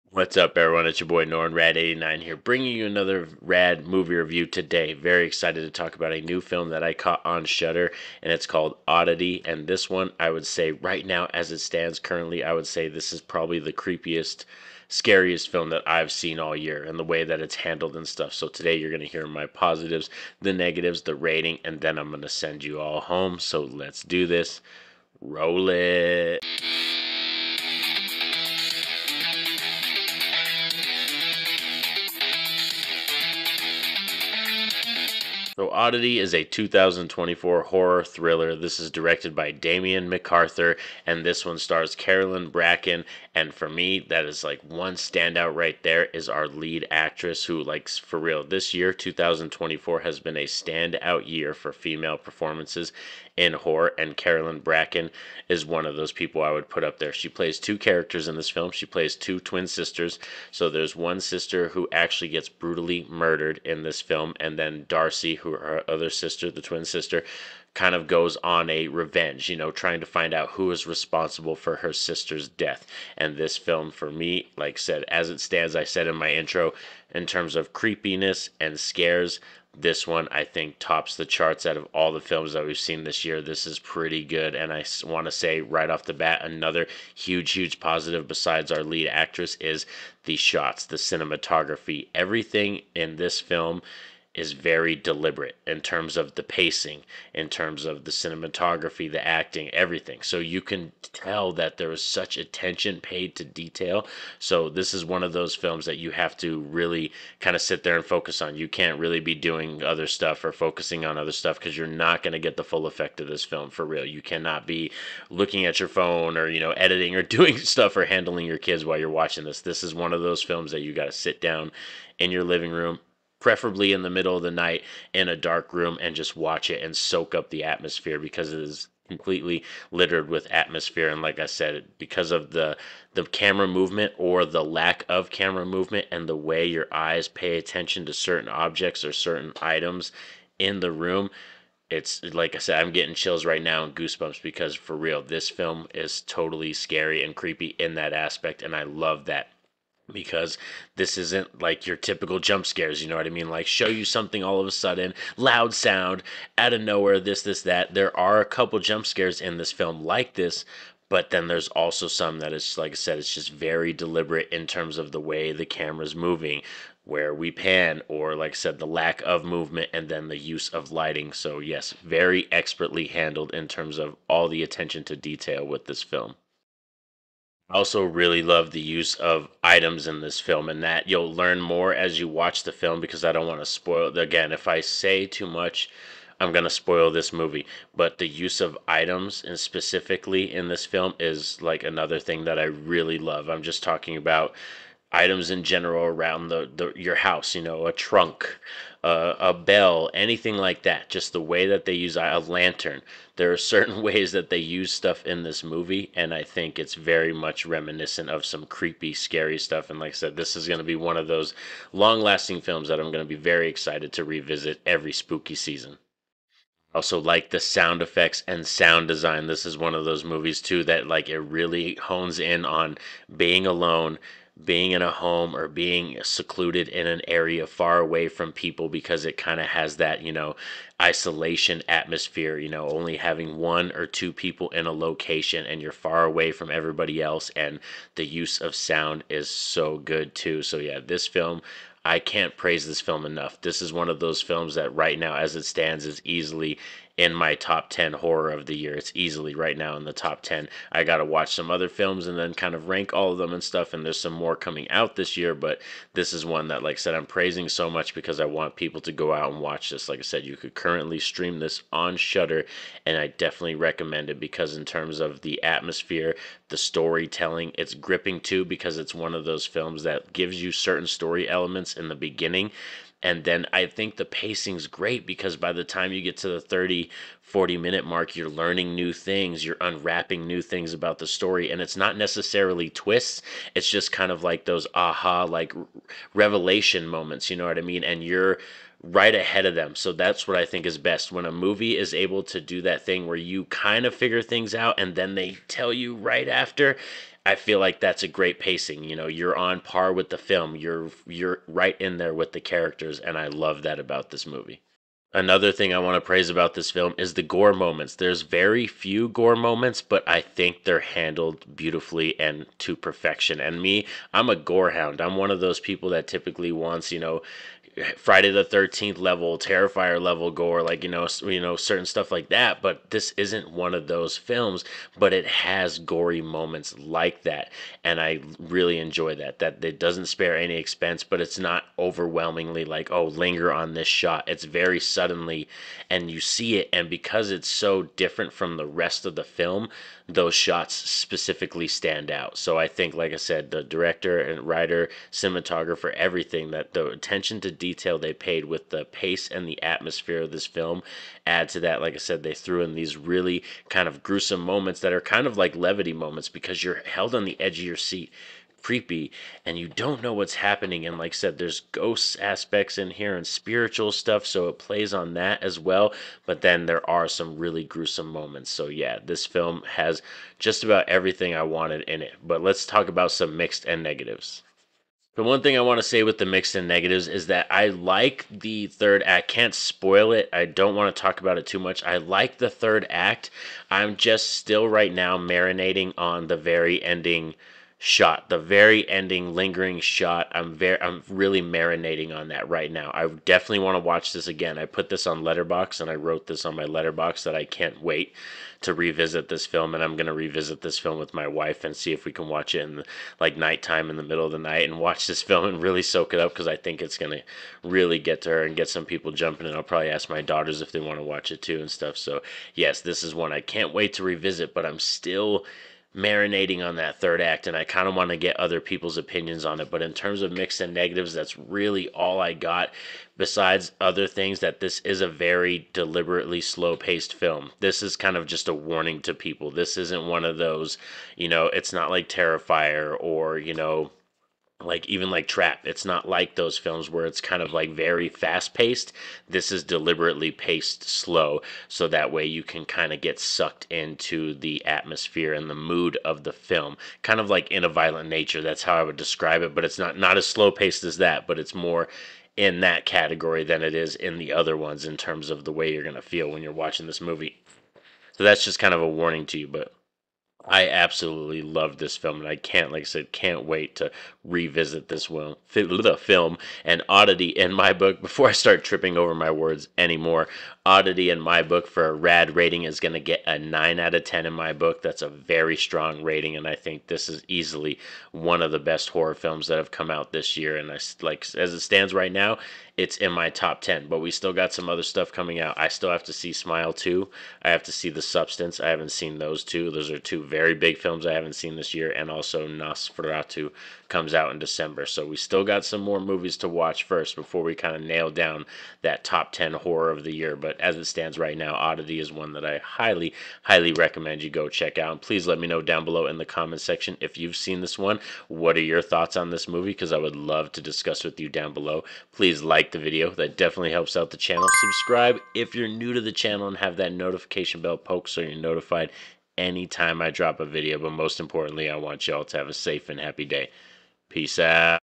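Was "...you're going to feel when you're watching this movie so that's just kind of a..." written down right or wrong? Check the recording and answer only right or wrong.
right.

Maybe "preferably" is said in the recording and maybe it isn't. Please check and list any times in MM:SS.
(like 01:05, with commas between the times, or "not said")
02:03.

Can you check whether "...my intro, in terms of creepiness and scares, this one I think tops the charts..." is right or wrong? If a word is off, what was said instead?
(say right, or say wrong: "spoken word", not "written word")
right.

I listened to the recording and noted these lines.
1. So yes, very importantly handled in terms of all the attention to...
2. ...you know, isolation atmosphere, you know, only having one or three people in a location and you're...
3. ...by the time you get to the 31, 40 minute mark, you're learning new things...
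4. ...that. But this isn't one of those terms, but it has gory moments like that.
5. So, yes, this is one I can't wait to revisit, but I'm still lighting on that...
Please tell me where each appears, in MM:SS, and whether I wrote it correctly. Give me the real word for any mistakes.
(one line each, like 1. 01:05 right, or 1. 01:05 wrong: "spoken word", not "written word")
1. 02:51 wrong: "expertly", not "importantly"
2. 03:50 wrong: "two", not "three"
3. 04:35 wrong: "30", not "31"
4. 05:22 wrong: "films", not "terms"
5. 06:52 wrong: "marinating", not "lighting".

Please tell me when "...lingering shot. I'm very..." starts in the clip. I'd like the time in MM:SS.
06:29.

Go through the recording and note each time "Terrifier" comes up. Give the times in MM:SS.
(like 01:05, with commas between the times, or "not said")
05:19, 07:12.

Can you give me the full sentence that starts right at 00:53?
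And Carolyn Bracken is one of those people I would put up there.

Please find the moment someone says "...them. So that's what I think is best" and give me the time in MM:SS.
04:49.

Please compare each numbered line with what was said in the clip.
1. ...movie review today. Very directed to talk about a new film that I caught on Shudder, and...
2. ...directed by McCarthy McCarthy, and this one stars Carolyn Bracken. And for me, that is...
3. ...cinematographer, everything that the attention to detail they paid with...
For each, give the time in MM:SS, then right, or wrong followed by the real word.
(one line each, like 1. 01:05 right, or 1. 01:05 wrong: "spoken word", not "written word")
1. 00:03 wrong: "excited", not "directed"
2. 00:38 wrong: "Damian", not "McCarthy"
3. 05:45 right.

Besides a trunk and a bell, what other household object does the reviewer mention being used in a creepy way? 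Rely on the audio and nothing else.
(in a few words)
A lantern.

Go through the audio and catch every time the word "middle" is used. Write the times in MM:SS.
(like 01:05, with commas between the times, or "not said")
02:04, 06:44.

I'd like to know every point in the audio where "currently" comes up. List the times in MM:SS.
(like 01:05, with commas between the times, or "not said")
00:11, 04:20.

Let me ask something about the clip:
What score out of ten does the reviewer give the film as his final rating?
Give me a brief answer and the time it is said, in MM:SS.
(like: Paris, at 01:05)
9, at 07:53.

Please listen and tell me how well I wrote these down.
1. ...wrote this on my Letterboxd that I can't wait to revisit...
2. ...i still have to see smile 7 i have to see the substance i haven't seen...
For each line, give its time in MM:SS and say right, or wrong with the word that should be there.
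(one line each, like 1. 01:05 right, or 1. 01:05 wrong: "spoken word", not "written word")
1. 06:36 right
2. 08:05 wrong: "2", not "7".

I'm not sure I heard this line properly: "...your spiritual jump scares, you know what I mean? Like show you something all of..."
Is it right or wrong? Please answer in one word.
wrong.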